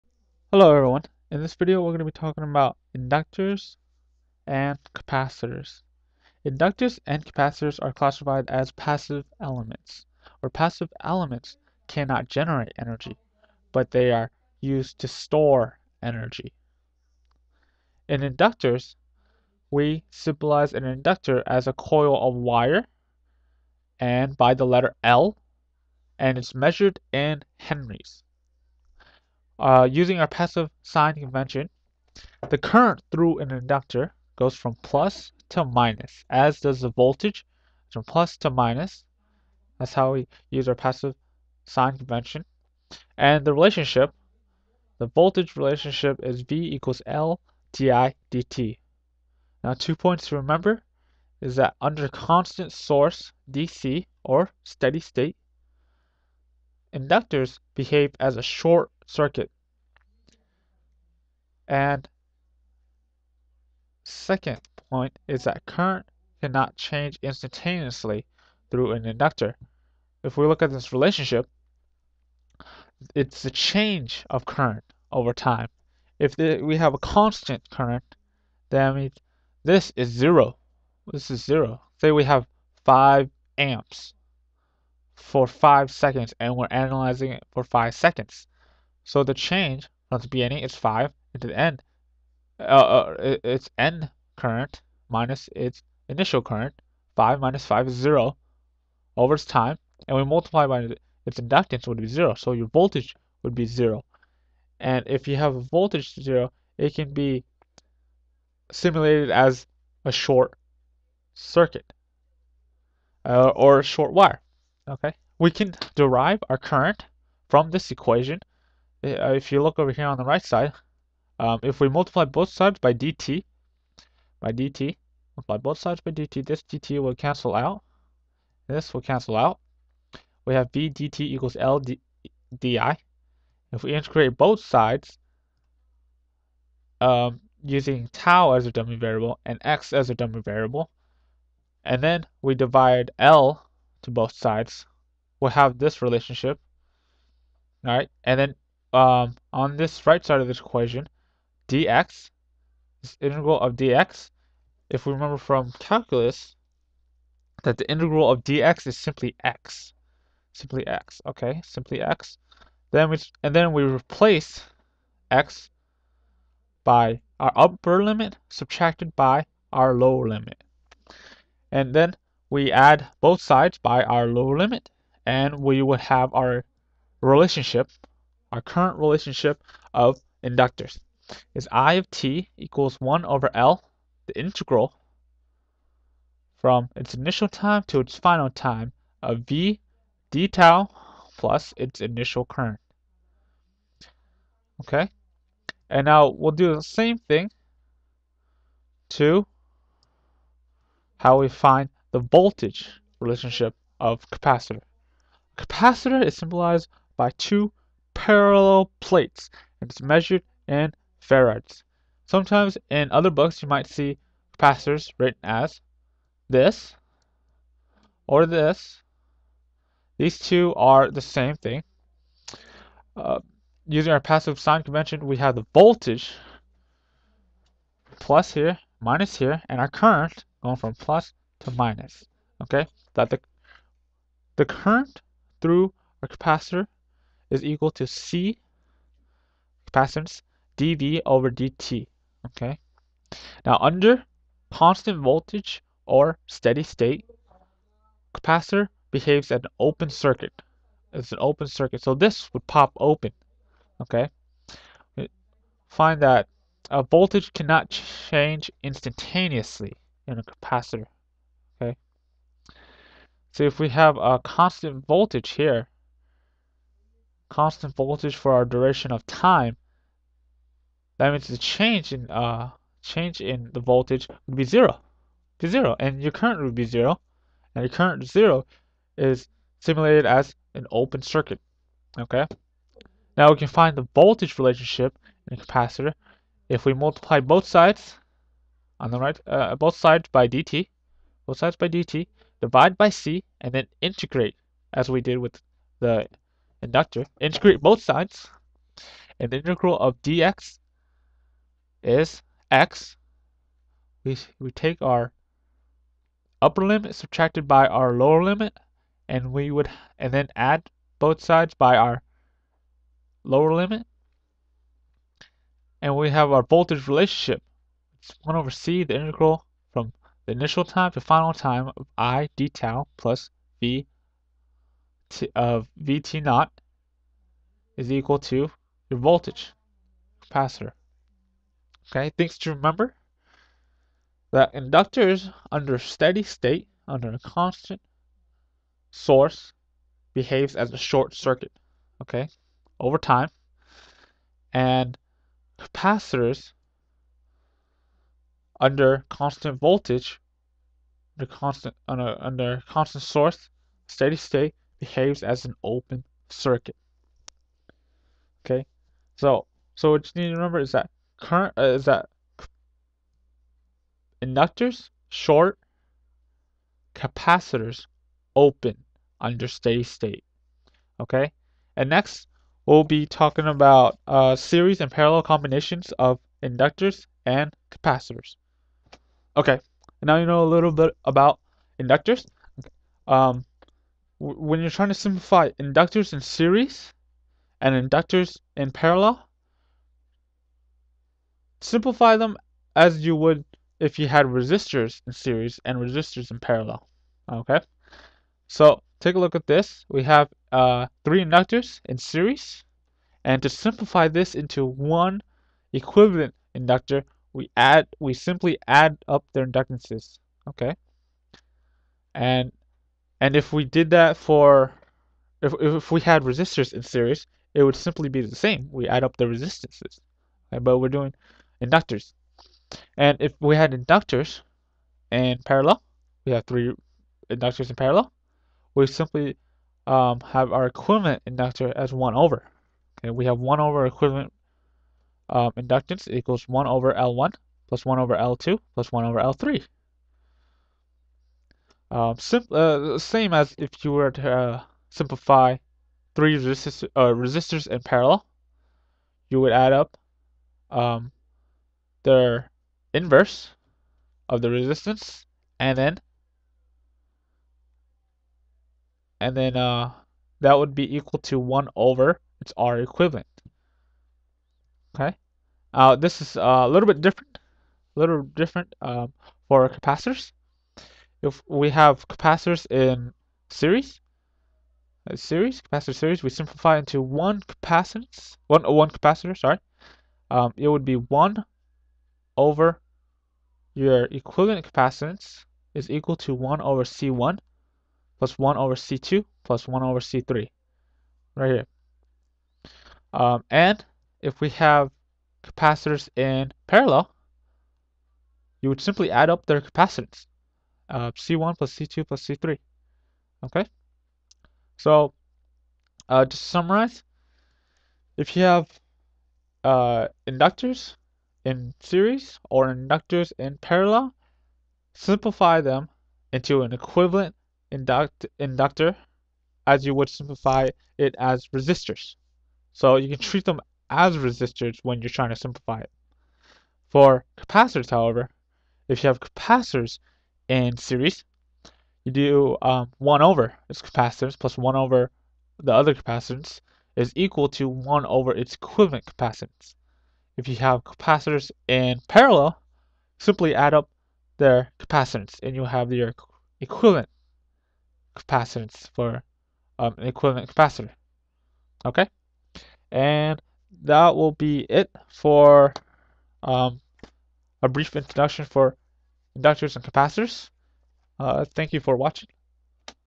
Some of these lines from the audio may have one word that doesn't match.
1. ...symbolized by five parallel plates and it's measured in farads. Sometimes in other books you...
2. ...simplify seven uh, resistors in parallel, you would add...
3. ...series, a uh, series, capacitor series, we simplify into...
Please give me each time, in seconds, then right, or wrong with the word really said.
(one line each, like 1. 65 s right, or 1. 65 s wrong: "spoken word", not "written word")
1. 206 s wrong: "two", not "five"
2. 445 s wrong: "three", not "seven"
3. 473 s right.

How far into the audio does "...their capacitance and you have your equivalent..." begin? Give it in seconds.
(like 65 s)
544 s.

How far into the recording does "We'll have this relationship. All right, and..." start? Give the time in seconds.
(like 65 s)
145 s.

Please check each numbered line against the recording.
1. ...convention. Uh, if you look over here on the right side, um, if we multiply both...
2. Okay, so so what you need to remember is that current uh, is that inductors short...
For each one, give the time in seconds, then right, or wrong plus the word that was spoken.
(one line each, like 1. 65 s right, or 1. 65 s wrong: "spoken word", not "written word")
1. 117 s wrong: "equation", not "convention"
2. 358 s right.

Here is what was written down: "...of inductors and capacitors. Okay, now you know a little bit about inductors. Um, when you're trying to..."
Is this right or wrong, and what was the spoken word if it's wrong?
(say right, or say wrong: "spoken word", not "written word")
right.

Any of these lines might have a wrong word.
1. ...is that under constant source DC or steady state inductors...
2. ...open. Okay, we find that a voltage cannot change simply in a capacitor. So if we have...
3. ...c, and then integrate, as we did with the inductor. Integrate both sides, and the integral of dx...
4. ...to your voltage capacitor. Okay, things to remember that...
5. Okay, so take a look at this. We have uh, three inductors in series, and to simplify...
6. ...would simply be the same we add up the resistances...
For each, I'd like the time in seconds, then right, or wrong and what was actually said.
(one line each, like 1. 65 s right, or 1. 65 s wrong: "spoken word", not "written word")
1. 51 s right
2. 252 s wrong: "instantaneously", not "simply"
3. 293 s right
4. 328 s right
5. 397 s right
6. 417 s right.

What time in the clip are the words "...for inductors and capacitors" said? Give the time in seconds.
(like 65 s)
558 s.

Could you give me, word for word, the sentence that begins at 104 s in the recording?
And if you have a voltage 0, it can be simulated as a short circuit uh, or a short wire.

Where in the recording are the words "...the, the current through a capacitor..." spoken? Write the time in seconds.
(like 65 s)
233 s.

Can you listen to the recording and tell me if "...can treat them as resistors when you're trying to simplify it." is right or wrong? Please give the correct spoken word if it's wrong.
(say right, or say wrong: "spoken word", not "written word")
right.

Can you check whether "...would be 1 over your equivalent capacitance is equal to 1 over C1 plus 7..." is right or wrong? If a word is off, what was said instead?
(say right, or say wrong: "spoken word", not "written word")
wrong: "1", not "7".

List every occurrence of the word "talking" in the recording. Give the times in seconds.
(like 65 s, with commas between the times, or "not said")
2 s, 373 s.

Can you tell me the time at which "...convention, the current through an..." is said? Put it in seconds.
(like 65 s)
31 s.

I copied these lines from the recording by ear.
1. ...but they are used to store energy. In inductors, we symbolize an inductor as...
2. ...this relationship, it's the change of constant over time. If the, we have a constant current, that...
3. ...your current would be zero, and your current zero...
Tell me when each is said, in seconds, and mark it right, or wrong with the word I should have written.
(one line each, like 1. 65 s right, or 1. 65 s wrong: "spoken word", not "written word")
1. 13 s right
2. 70 s wrong: "current", not "constant"
3. 276 s right.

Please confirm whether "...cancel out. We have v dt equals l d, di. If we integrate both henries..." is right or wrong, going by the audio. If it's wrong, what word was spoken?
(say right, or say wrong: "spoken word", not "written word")
wrong: "sides", not "henries".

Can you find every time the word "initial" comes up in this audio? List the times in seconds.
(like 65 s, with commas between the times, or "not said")
96 s, 187 s, 192 s, 320 s.